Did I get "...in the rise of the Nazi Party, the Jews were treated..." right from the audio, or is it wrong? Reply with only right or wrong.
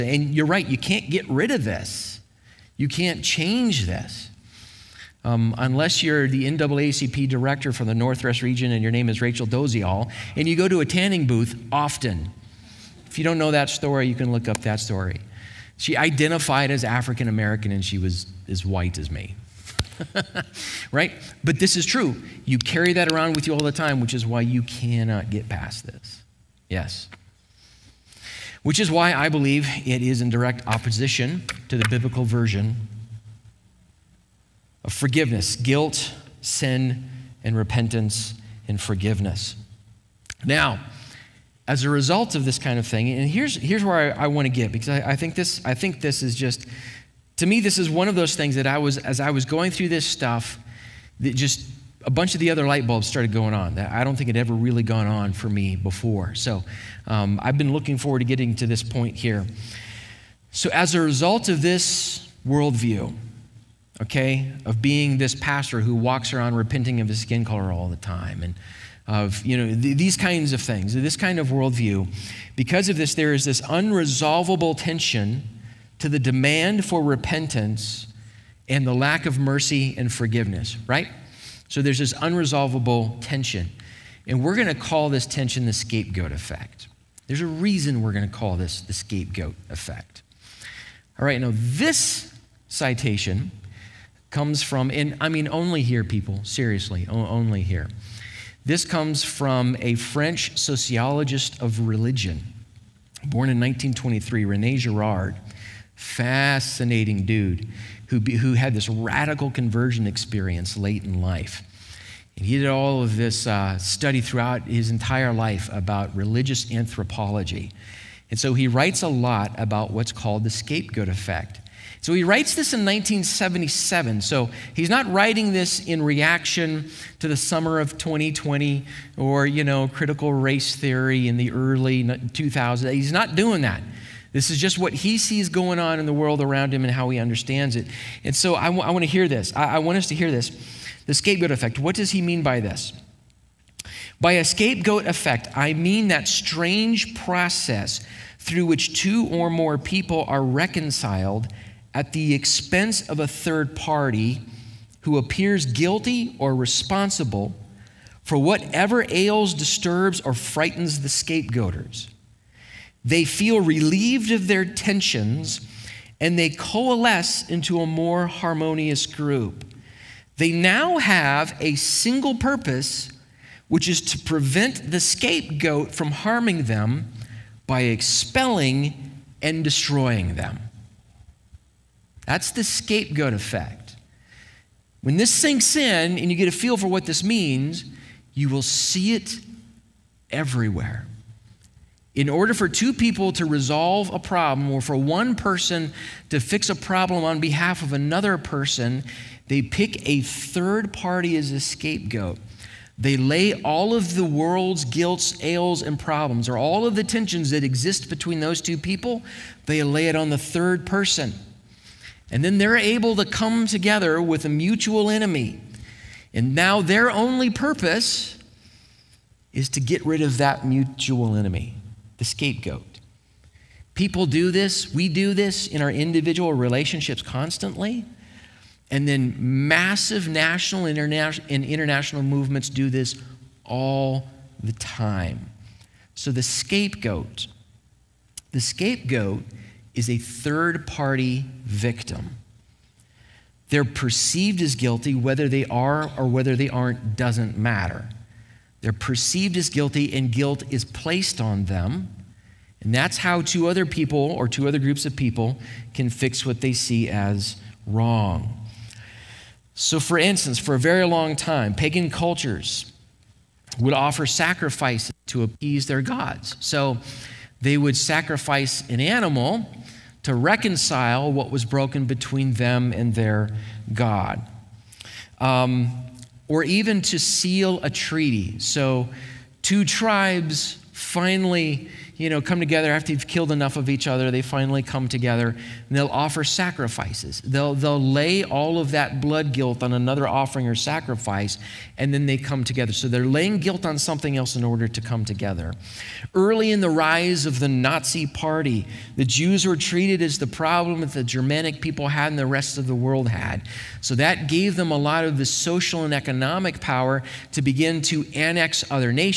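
right.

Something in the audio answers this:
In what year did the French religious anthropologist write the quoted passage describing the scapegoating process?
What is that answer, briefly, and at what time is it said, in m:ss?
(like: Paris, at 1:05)
1977, at 2:02.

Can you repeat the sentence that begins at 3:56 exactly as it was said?
So the scapegoat, the scapegoat is a third party victim.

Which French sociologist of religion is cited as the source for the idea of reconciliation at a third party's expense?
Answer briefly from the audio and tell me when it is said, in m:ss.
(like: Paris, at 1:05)
Rene Girard, at 1:44.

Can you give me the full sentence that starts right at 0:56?
So um, I've been looking forward to getting to this point here.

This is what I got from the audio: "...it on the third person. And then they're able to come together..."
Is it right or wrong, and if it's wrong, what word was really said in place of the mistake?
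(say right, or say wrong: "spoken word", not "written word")
right.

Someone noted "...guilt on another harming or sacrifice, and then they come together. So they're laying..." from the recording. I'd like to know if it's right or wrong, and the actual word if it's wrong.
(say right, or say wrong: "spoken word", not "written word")
wrong: "offering", not "harming".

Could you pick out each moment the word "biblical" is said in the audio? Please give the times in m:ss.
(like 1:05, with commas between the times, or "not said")
0:31.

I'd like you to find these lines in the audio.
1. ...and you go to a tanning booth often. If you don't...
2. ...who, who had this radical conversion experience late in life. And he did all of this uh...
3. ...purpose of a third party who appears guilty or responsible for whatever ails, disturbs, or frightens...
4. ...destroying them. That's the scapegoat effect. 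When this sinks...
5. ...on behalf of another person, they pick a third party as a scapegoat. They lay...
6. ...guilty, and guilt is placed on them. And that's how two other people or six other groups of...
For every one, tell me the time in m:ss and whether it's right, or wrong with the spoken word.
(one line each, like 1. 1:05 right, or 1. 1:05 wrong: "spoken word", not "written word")
1. 0:10 right
2. 1:48 right
3. 2:32 wrong: "expense", not "purpose"
4. 2:59 right
5. 3:17 right
6. 4:09 wrong: "two", not "six".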